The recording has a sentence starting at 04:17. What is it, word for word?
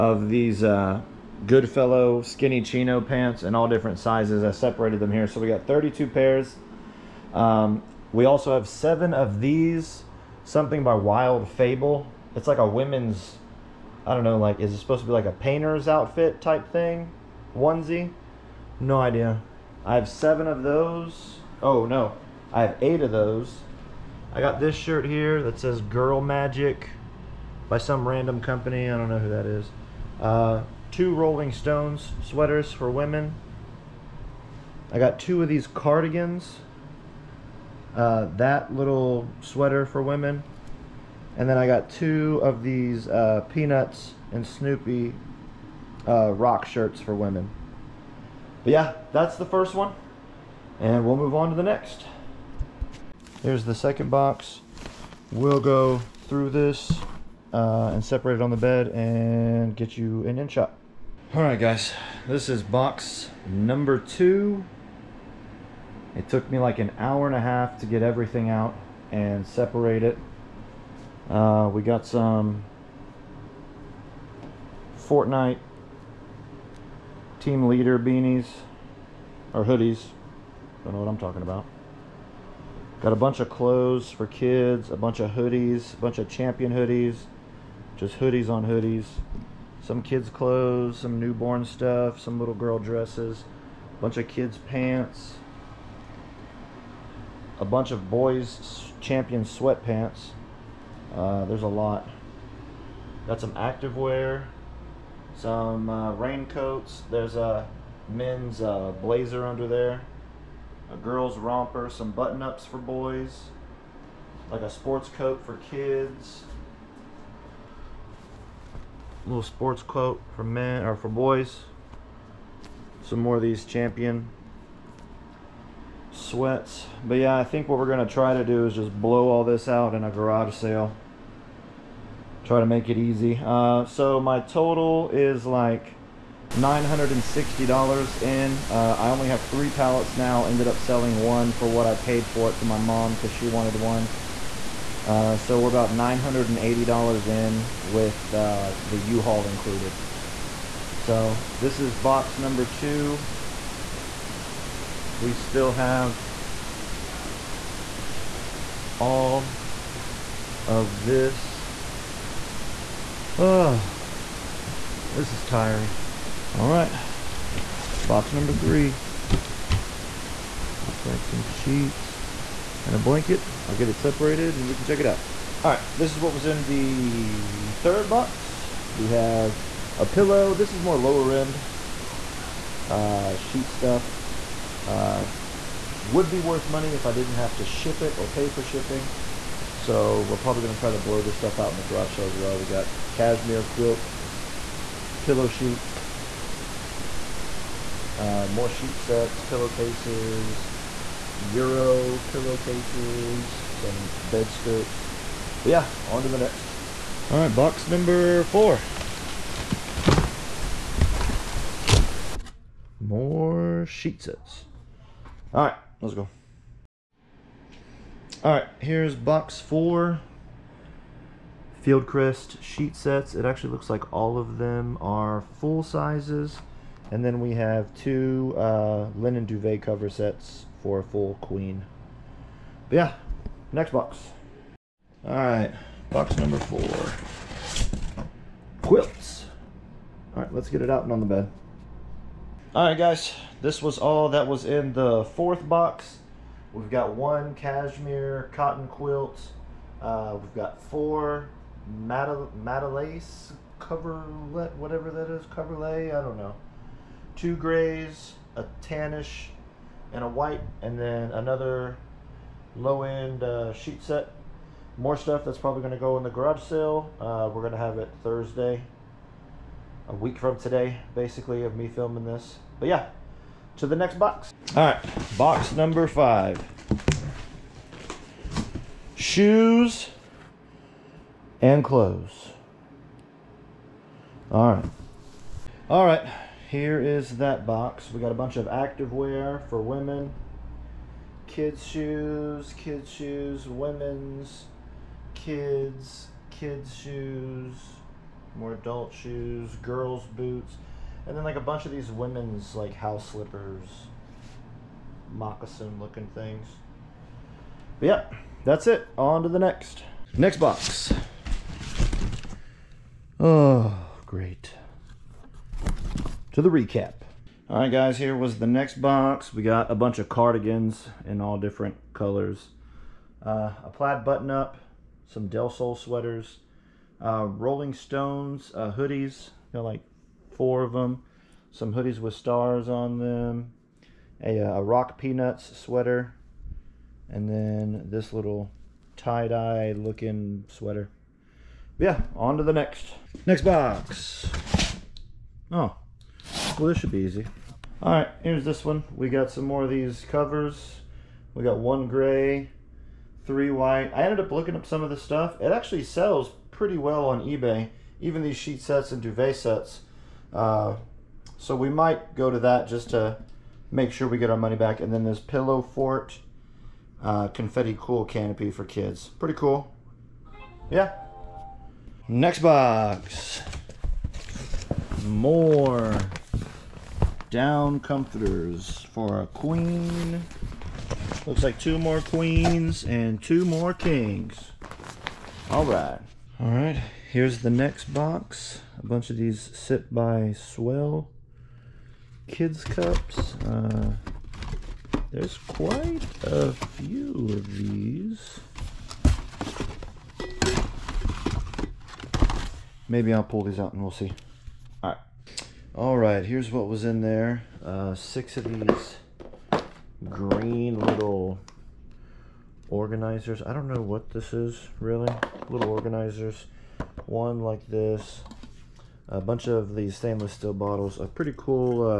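Two grays, a tannish, and a white, and then another low-end uh, sheet set.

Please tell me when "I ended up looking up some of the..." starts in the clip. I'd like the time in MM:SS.
05:54.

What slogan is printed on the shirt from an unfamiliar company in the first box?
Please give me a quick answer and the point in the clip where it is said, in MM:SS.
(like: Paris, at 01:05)
Girl Magic, at 00:25.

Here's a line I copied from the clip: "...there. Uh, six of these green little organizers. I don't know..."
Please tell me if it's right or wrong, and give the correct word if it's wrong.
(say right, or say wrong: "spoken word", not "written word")
right.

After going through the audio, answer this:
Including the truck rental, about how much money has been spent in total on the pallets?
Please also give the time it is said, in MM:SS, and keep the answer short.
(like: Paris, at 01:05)
$980, at 02:25.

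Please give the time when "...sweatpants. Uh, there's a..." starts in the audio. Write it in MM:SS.
01:39.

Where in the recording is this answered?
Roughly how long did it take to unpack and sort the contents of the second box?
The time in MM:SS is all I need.
01:06.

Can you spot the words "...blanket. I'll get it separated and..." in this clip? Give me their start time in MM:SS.
02:52.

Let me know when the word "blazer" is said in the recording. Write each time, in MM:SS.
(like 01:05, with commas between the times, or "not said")
01:49.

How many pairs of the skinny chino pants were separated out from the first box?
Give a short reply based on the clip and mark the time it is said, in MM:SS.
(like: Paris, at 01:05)
32, at 00:05.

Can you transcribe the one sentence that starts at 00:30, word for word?
Uh, two Rolling Stones sweaters for women.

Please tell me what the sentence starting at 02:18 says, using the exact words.
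Uh, I only have three pallets now.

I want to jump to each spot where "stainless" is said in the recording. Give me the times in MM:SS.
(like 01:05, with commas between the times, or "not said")
07:00.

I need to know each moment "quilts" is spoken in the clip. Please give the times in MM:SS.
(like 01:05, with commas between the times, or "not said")
03:13, 03:58, 04:08.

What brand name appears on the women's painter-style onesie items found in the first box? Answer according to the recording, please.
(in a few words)
Wild Fable.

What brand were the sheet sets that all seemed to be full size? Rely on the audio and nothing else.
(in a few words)
Fieldcrest.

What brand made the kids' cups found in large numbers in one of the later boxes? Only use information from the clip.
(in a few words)
Sip by Swell.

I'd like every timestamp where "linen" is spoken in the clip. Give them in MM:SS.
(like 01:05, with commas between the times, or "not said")
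03:49.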